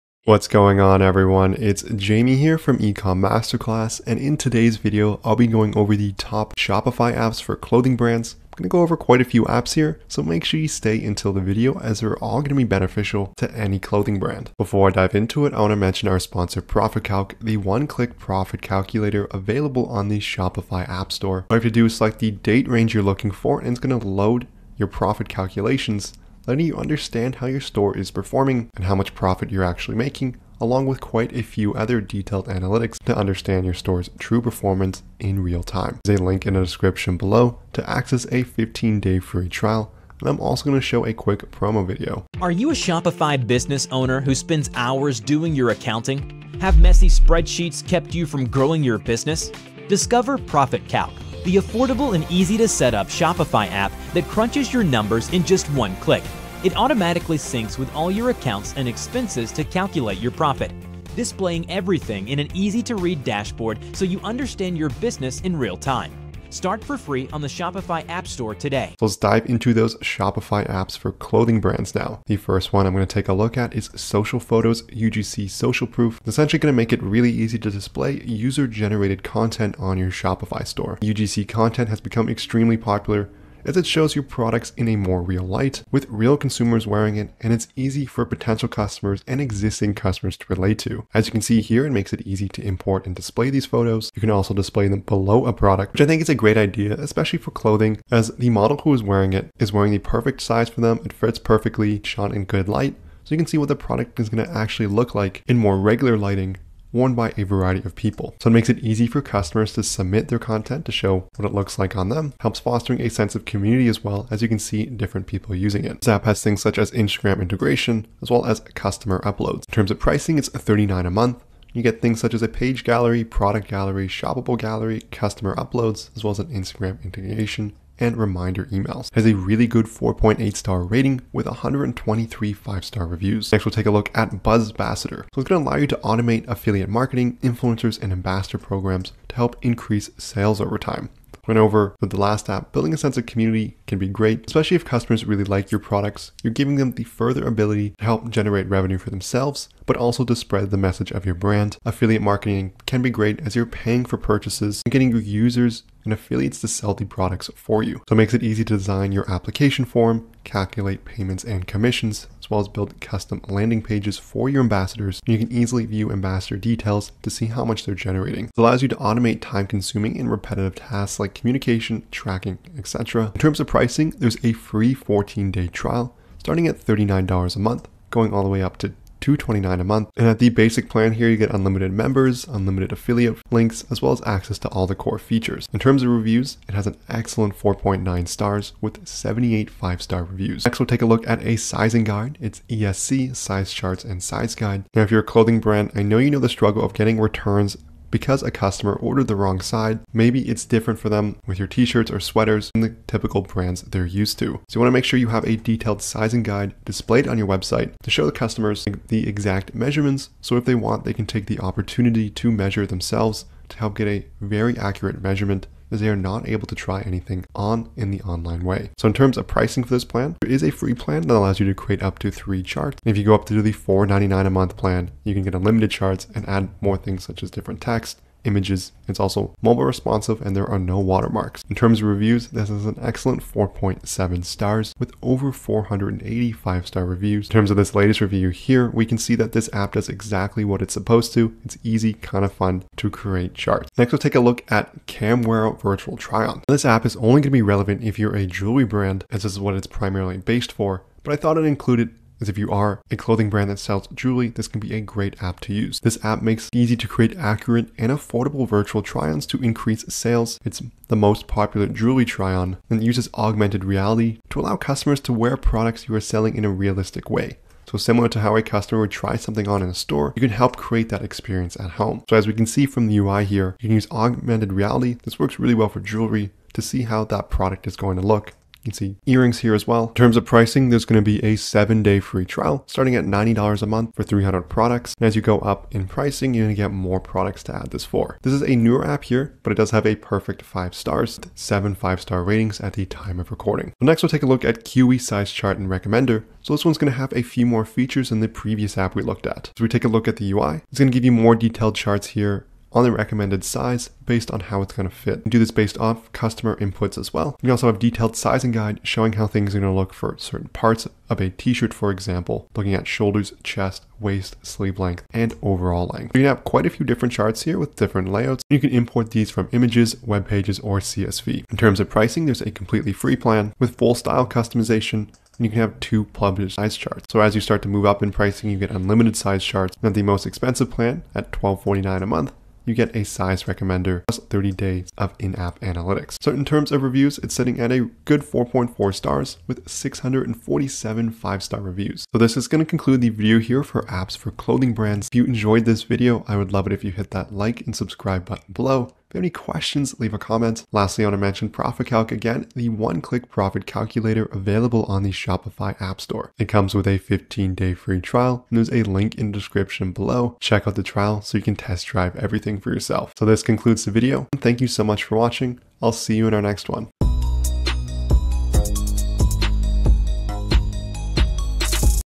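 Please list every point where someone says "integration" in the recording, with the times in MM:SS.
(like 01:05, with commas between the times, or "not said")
01:57, 02:07.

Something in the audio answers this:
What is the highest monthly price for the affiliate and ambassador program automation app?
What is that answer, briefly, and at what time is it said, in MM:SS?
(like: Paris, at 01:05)
$229, at 02:59.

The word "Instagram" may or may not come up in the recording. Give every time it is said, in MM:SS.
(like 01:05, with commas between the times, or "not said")
01:56, 02:06.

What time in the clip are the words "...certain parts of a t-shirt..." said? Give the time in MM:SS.
05:10.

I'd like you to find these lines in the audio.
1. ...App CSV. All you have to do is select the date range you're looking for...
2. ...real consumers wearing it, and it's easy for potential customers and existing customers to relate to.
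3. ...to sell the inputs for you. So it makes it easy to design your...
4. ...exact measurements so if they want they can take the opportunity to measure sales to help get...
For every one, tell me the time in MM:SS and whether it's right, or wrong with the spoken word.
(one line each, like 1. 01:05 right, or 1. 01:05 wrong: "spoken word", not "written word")
1. 00:20 wrong: "Store", not "CSV"
2. 01:26 right
3. 02:36 wrong: "products", not "inputs"
4. 03:29 wrong: "themselves", not "sales".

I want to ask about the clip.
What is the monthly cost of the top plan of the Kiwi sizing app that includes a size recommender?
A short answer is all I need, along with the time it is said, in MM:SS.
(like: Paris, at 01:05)
$12.49, at 05:31.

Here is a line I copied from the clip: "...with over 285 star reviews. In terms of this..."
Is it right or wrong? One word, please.
wrong.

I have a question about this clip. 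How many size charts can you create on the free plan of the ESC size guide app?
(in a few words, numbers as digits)
3.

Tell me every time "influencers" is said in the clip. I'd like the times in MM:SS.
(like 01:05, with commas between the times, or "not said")
02:17.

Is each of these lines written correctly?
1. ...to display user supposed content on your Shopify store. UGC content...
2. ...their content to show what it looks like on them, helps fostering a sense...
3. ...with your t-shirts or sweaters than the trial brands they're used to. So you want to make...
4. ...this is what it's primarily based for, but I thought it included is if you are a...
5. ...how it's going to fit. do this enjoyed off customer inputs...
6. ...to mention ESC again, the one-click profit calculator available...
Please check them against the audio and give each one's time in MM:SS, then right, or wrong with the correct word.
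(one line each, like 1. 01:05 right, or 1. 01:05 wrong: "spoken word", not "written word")
1. 01:17 wrong: "generated", not "supposed"
2. 01:50 right
3. 03:21 wrong: "typical", not "trial"
4. 04:09 right
5. 05:04 wrong: "based", not "enjoyed"
6. 05:51 wrong: "ProfitCalc", not "ESC".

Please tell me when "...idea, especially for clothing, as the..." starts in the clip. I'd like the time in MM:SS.
01:36.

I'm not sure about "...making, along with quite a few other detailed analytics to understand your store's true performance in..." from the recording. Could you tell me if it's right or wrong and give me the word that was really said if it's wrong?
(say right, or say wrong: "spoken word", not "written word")
right.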